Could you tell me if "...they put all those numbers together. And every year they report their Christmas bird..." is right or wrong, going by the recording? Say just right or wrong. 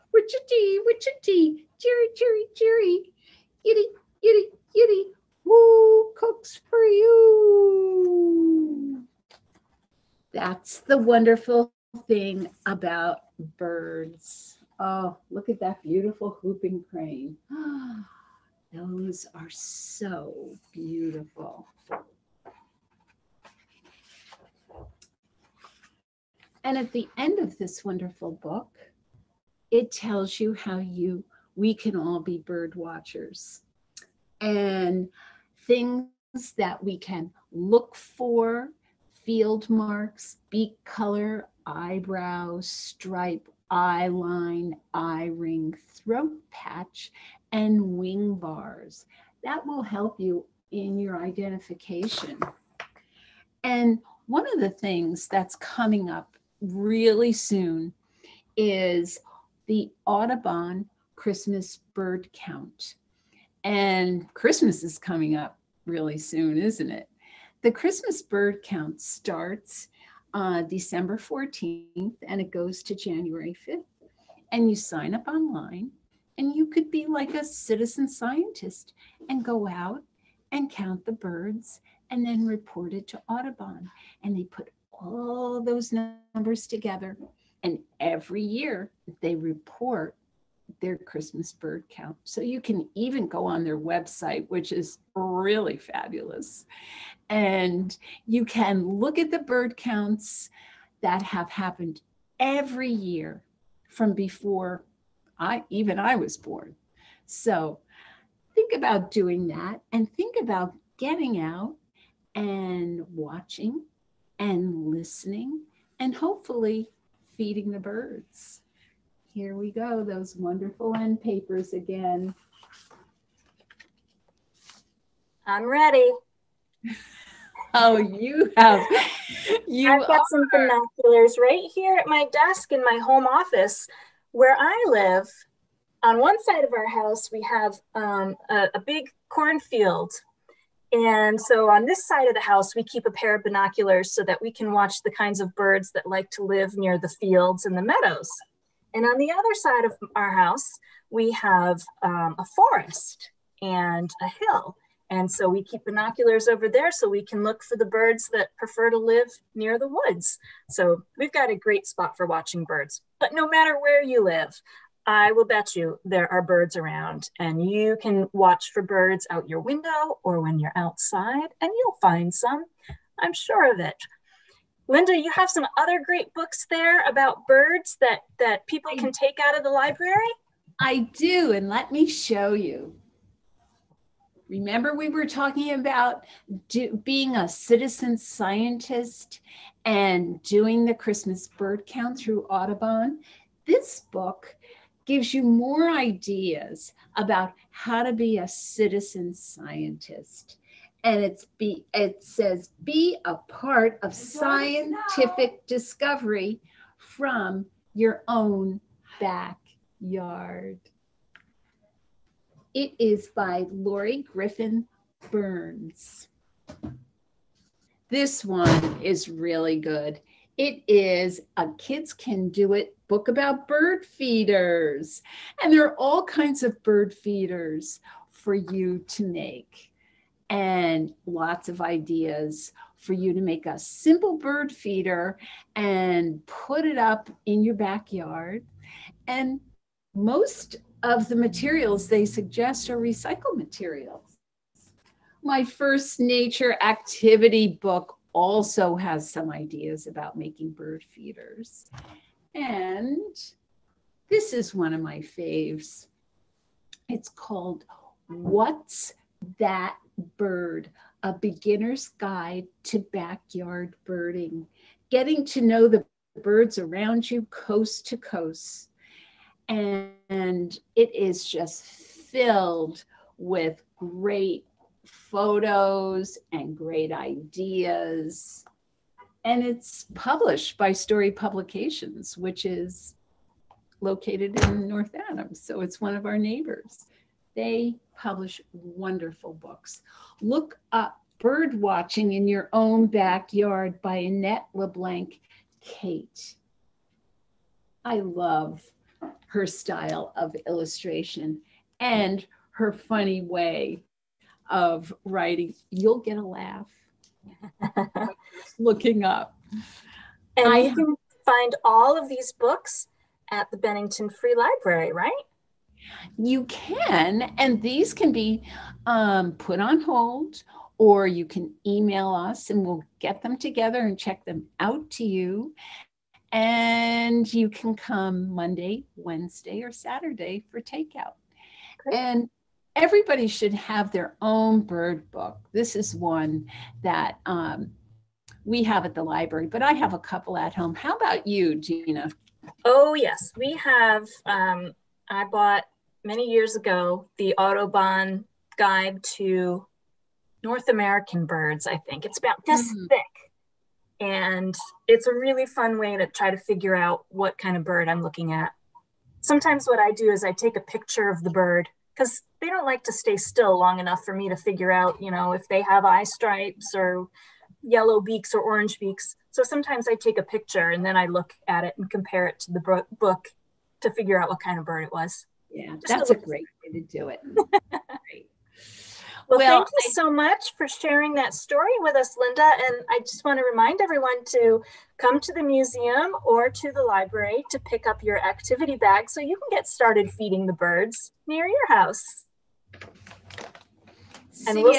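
right.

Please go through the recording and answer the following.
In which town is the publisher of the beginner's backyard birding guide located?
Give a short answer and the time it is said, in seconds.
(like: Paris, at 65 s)
North Adams, at 284 s.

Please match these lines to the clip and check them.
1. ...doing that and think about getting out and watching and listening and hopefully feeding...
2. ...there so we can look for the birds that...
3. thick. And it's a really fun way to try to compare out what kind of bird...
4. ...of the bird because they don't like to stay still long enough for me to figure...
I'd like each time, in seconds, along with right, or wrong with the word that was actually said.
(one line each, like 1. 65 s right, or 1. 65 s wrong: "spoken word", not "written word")
1. 109 s right
2. 156 s right
3. 353 s wrong: "figure", not "compare"
4. 361 s right.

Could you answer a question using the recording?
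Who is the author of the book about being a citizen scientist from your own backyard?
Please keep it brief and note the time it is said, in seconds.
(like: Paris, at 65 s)
Loree Griffin Burns, at 213 s.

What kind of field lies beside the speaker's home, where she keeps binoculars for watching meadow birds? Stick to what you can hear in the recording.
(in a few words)
cornfield.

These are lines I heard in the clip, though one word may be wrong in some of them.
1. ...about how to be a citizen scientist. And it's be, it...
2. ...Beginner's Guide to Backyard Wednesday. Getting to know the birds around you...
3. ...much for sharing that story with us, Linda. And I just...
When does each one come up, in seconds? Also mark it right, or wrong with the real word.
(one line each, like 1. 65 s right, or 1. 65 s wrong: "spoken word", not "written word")
1. 197 s right
2. 261 s wrong: "Birding", not "Wednesday"
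3. 380 s right.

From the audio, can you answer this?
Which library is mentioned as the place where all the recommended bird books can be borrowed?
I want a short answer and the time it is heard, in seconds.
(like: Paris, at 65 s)
Bennington Free Library, at 313 s.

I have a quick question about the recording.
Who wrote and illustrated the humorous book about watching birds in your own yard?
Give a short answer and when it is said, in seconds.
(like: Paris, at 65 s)
Annette LeBlanc Cate, at 294 s.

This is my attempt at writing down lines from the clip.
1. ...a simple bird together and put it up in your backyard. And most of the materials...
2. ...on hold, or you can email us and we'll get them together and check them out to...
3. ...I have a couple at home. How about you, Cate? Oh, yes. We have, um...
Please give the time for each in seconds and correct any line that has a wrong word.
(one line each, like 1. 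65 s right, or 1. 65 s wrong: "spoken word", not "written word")
1. 233 s wrong: "feeder", not "together"
2. 319 s right
3. 339 s wrong: "Deana", not "Cate".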